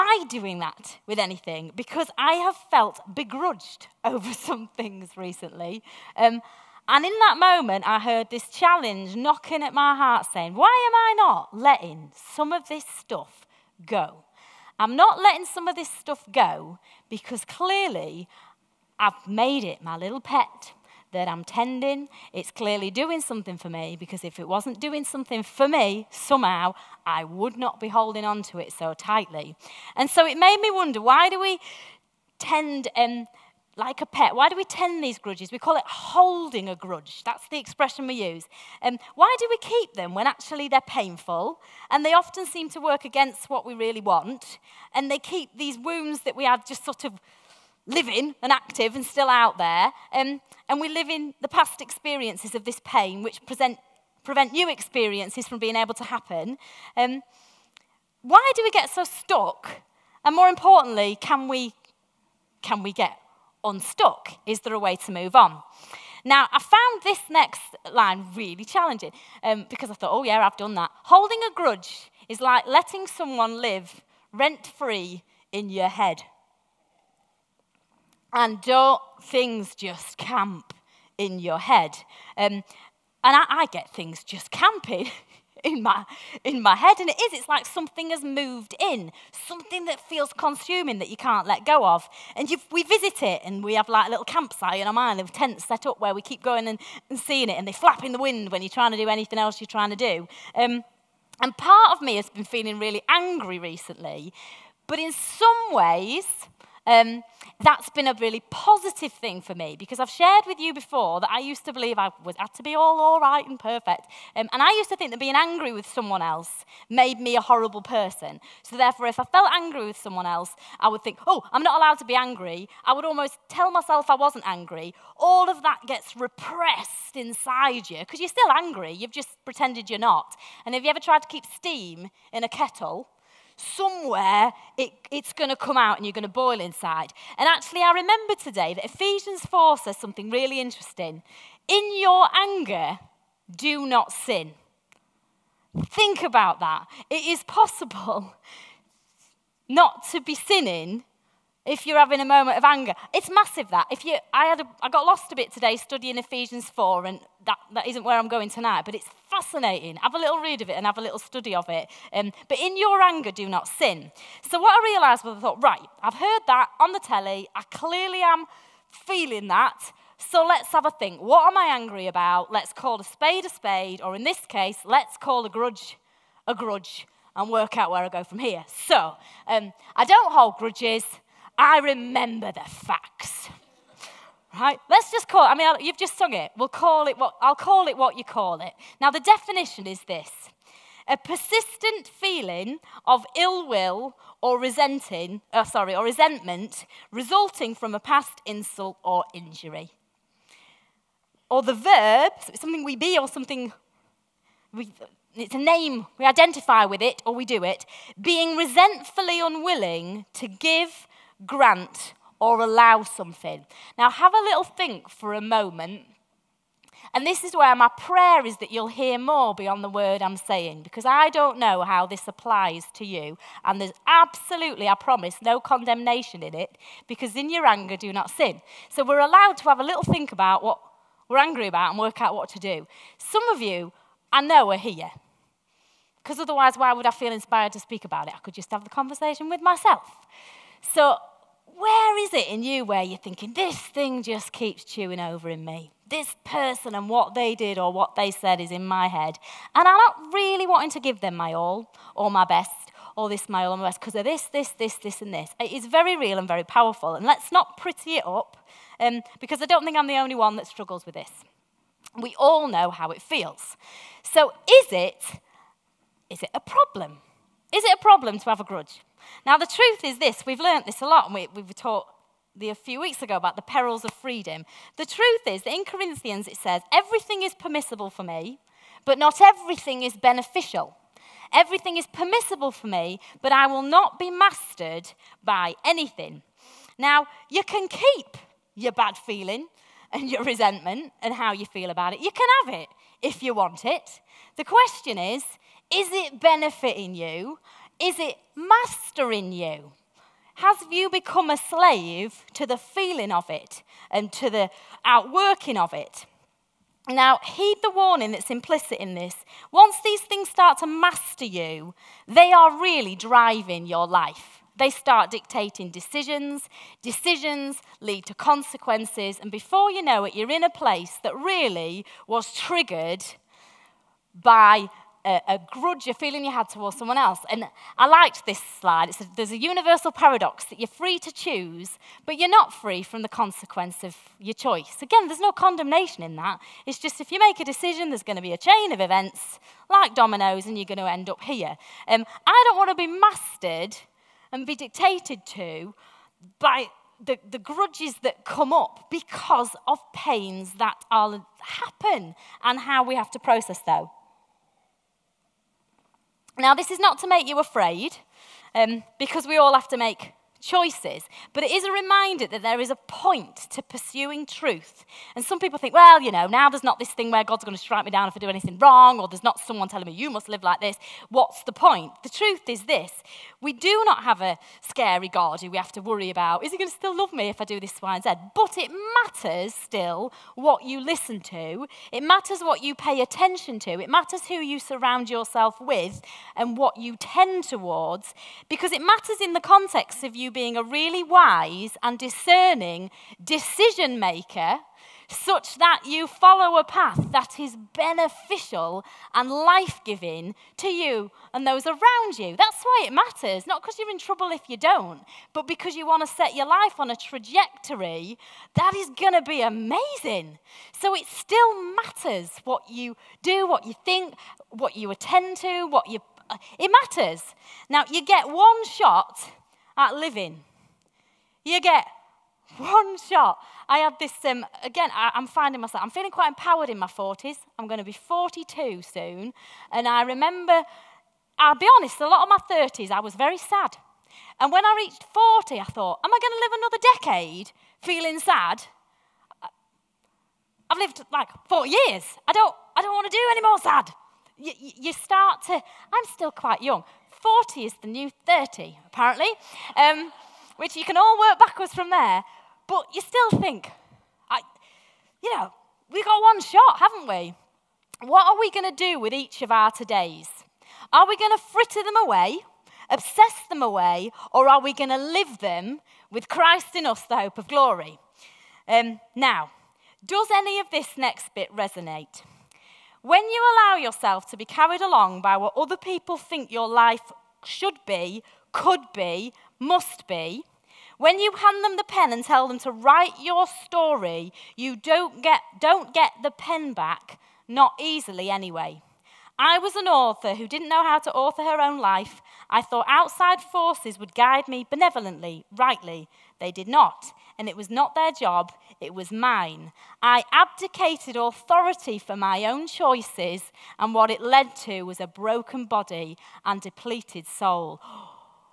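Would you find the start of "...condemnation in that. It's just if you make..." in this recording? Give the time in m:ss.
5:35.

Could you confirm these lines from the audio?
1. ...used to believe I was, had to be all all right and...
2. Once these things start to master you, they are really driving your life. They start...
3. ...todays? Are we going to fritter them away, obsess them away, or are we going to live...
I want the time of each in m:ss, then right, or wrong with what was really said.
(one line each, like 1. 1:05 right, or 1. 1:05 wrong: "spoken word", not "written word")
1. 1:51 right
2. 5:09 right
3. 7:39 right.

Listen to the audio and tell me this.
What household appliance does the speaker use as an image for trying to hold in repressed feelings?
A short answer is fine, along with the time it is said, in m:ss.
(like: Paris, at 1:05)
Kettle, at 2:12.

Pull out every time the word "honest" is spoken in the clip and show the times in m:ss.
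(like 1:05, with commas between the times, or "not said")
7:11.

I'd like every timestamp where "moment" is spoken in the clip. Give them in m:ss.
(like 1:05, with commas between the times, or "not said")
0:07, 2:32, 3:35.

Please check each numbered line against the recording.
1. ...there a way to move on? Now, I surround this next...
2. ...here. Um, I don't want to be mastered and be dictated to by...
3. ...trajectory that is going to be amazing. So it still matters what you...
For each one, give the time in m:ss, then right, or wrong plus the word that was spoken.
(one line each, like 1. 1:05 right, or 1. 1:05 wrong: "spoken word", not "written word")
1. 1:04 wrong: "found", not "surround"
2. 5:41 right
3. 6:47 right.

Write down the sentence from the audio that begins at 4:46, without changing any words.
Now, you can keep your bad feeling and your resentment and how you feel about it.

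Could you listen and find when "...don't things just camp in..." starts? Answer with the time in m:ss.
1:18.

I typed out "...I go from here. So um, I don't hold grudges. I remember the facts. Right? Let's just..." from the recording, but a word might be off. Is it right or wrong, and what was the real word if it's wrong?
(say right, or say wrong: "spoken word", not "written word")
right.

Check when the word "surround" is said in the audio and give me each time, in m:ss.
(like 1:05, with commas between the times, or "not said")
6:24.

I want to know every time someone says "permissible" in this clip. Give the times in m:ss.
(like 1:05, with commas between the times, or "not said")
4:37, 4:42.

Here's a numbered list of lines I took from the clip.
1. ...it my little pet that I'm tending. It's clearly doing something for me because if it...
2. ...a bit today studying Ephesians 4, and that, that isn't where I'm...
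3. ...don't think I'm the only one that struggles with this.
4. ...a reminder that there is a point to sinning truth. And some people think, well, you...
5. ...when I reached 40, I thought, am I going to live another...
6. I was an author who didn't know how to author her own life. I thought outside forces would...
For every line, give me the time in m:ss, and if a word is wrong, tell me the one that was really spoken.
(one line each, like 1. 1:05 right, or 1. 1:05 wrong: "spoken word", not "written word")
1. 0:19 right
2. 2:35 right
3. 4:19 right
4. 6:01 wrong: "pursuing", not "sinning"
5. 7:14 right
6. 8:09 right.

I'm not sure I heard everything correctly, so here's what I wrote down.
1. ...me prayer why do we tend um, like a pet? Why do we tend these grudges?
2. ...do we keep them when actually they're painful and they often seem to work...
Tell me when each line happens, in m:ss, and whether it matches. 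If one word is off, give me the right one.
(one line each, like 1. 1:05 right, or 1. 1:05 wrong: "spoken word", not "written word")
1. 0:30 wrong: "wonder", not "prayer"
2. 0:39 right.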